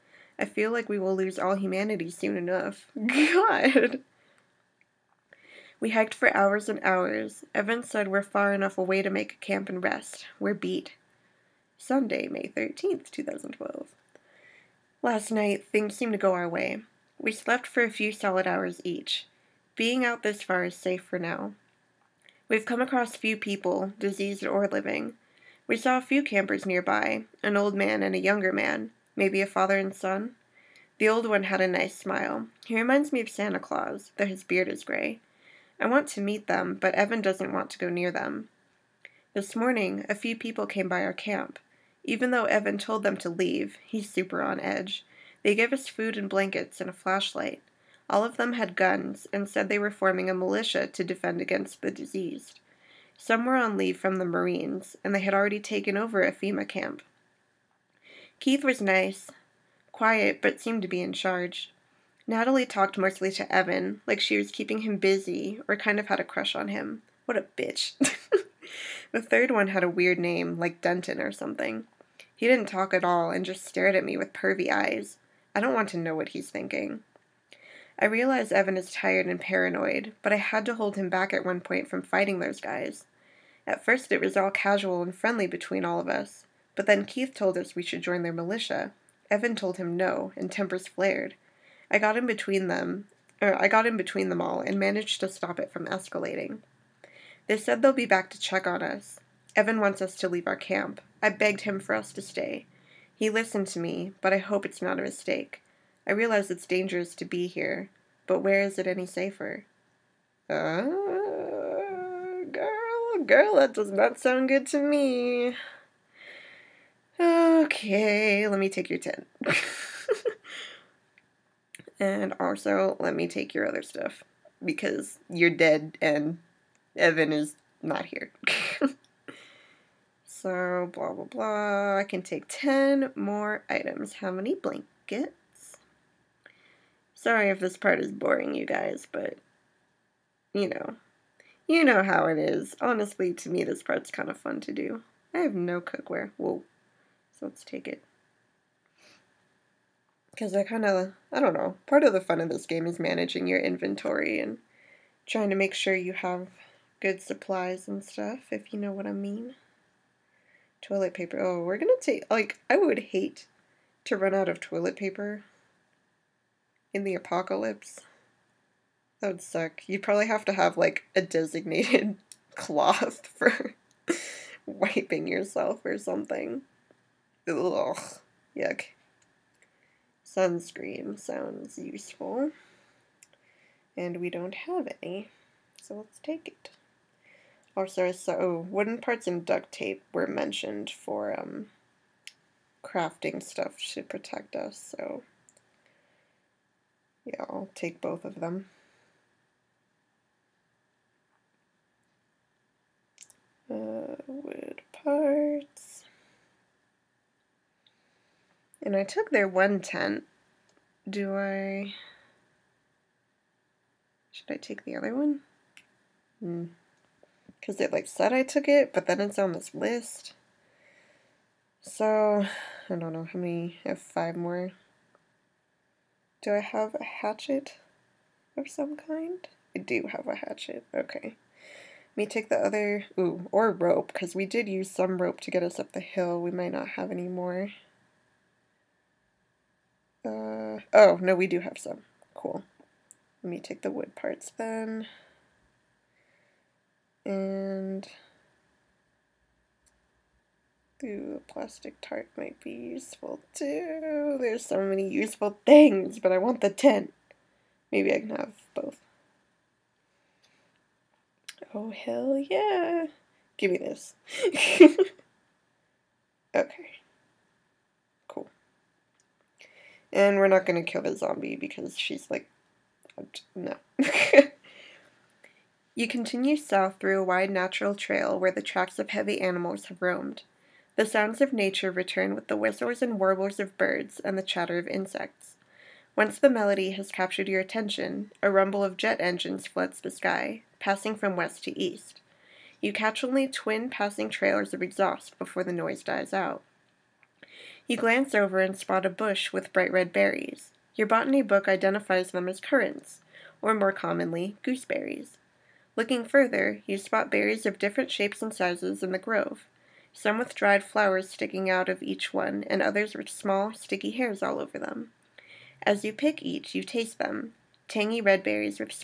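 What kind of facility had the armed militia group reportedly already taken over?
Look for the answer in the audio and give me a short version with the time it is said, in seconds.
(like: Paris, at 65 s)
FEMA camp, at 56 s.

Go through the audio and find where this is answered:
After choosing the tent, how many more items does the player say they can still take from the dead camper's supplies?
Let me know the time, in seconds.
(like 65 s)
132 s.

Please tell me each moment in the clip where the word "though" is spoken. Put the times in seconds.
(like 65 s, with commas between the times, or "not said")
34 s, 42 s.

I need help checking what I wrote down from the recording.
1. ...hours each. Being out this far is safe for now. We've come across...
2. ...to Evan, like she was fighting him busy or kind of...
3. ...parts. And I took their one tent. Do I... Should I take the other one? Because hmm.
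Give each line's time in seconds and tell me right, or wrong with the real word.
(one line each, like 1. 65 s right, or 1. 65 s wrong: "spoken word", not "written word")
1. 18 s right
2. 63 s wrong: "keeping", not "fighting"
3. 205 s right.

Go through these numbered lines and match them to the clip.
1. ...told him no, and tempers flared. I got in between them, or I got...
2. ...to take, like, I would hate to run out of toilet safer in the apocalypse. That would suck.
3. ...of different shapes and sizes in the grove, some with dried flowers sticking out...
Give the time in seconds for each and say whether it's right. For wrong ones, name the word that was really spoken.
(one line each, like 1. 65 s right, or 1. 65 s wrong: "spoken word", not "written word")
1. 89 s right
2. 161 s wrong: "paper", not "safer"
3. 307 s right.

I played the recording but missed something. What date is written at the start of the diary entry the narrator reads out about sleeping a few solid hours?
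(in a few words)
Sunday, May 13th, 2012.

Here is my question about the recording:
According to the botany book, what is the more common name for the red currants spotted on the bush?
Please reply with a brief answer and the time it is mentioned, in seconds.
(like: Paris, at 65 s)
gooseberries, at 304 s.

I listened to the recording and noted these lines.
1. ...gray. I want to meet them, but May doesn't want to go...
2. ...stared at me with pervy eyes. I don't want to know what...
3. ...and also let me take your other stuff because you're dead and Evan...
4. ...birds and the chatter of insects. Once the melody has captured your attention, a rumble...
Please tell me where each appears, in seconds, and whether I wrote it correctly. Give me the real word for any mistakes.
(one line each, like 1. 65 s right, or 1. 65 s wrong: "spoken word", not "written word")
1. 34 s wrong: "Evan", not "May"
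2. 73 s right
3. 121 s right
4. 283 s right.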